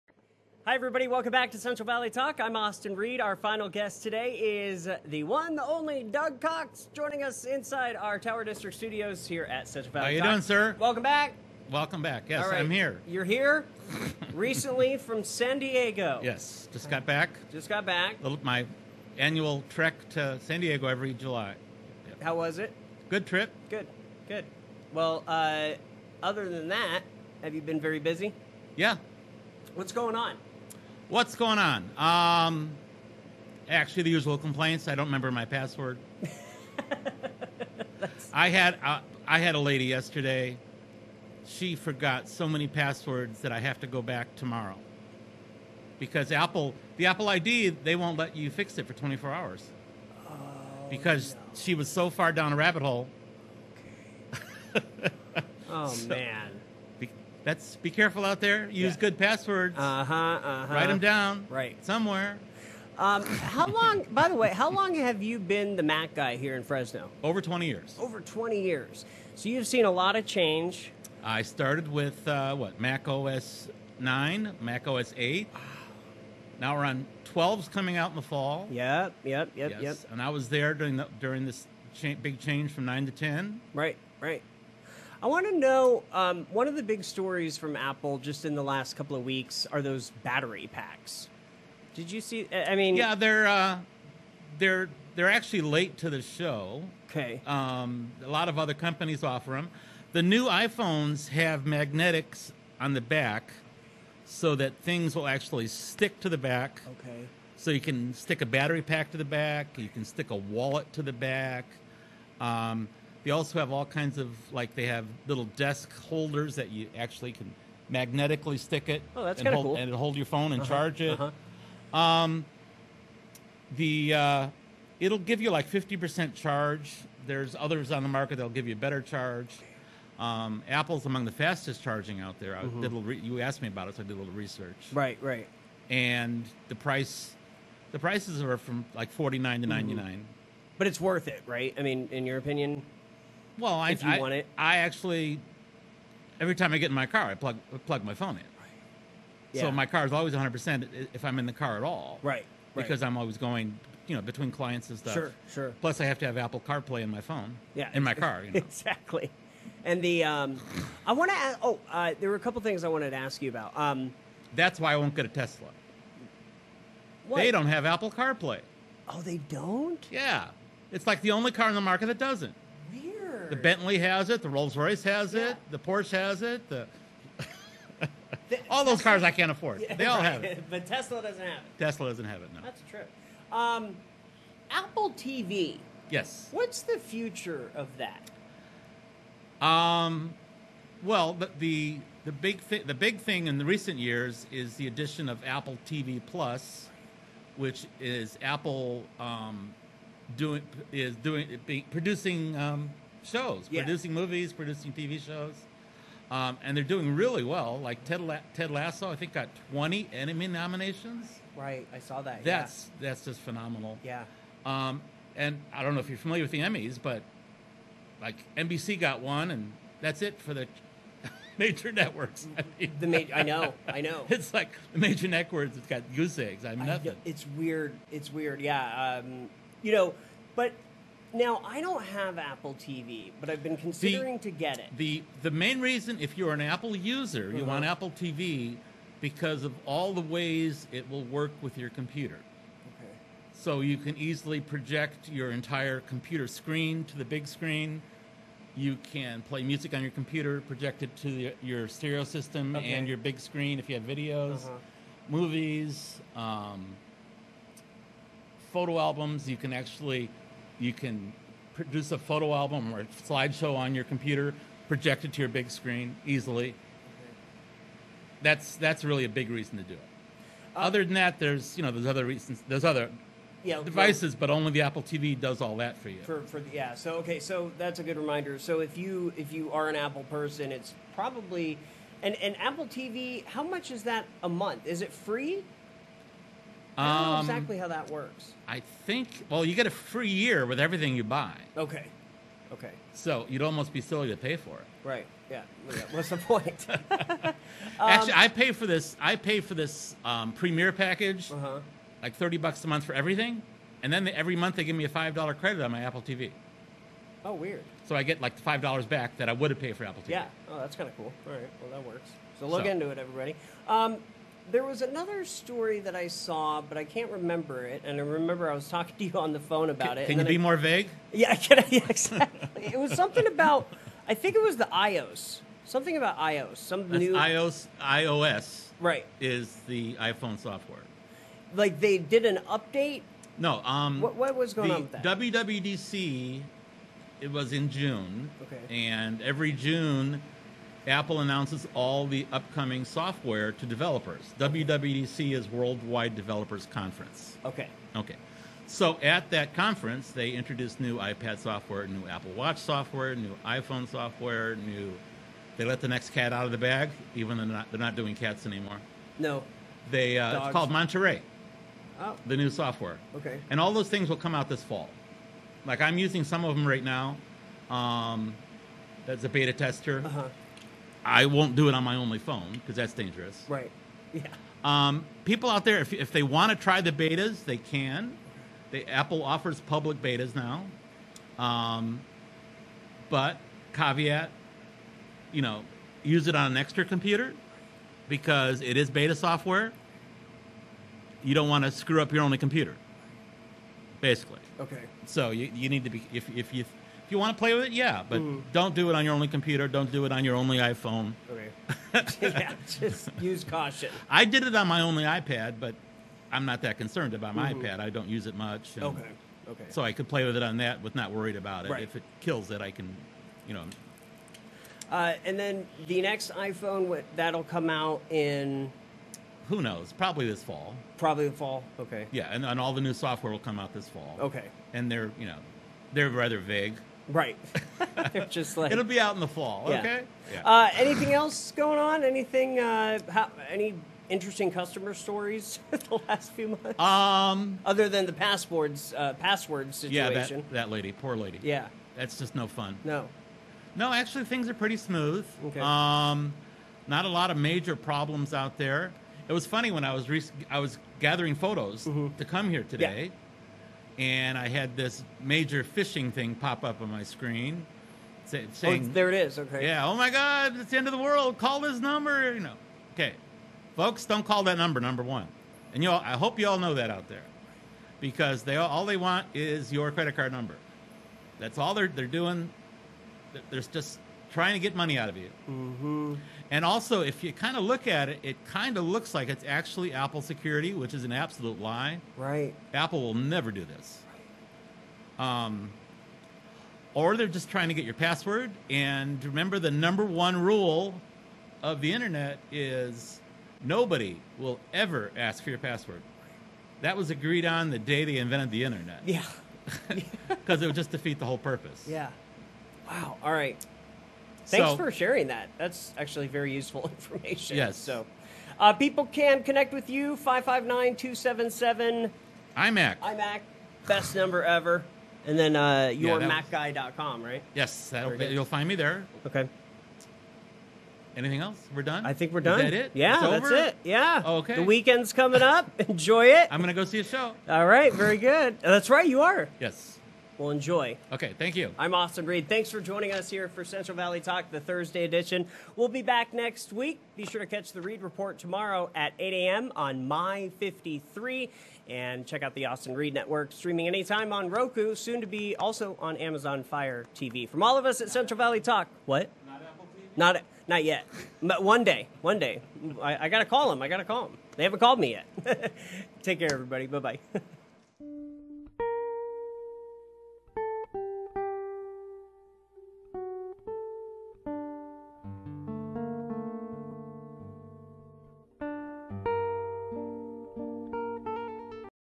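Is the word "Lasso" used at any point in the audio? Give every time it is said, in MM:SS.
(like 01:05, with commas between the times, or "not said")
03:28.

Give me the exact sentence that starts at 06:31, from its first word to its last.
You don't want to screw up your only computer, basically.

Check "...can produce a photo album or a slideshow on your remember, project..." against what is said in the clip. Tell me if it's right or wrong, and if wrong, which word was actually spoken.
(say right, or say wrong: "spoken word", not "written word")
wrong: "computer", not "remember".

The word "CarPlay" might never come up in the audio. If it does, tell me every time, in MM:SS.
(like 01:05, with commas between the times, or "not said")
02:36, 02:48.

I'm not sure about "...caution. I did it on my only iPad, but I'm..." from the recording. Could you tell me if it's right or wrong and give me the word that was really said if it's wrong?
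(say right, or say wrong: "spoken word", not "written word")
right.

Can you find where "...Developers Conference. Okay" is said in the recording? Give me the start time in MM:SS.
05:46.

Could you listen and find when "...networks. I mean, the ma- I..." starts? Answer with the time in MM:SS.
03:41.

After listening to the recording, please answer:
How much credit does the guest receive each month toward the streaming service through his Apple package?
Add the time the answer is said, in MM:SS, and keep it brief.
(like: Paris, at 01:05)
$5, at 05:05.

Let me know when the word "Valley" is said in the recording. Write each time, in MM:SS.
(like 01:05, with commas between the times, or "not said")
00:01, 00:09, 08:54, 09:08.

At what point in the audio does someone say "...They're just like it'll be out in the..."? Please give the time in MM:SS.
07:08.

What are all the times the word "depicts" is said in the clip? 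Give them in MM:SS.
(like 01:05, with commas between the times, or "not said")
not said.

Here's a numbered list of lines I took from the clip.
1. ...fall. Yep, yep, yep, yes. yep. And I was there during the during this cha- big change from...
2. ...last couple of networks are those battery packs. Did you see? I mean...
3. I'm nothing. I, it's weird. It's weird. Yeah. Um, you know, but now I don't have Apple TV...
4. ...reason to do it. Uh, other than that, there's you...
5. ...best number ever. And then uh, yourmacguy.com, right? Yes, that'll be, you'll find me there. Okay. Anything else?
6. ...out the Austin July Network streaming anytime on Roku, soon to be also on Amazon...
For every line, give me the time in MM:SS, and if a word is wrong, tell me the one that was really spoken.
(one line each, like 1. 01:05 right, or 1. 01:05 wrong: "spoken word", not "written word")
1. 01:18 right
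2. 01:28 wrong: "weeks", not "networks"
3. 03:46 right
4. 04:29 right
5. 08:34 right
6. 09:02 wrong: "Reed", not "July".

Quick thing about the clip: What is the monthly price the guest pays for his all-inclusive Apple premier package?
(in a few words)
$30.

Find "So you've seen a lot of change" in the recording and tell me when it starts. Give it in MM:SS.
01:09.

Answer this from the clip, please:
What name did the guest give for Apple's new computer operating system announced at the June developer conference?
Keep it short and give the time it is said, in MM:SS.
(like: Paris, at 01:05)
Monterey, at 06:00.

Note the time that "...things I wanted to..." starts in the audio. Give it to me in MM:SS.
02:42.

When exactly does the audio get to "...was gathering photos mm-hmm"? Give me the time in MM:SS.
07:30.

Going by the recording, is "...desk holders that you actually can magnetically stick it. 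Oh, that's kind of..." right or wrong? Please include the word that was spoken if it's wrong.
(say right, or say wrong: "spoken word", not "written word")
right.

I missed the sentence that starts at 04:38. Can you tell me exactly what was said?
So if you if you are an Apple person, it's probably and and Apple TV.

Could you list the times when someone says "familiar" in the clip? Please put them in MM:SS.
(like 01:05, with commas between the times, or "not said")
03:36.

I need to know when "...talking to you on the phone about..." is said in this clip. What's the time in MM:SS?
05:18.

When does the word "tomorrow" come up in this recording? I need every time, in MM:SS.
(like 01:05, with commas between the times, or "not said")
00:44, 08:58.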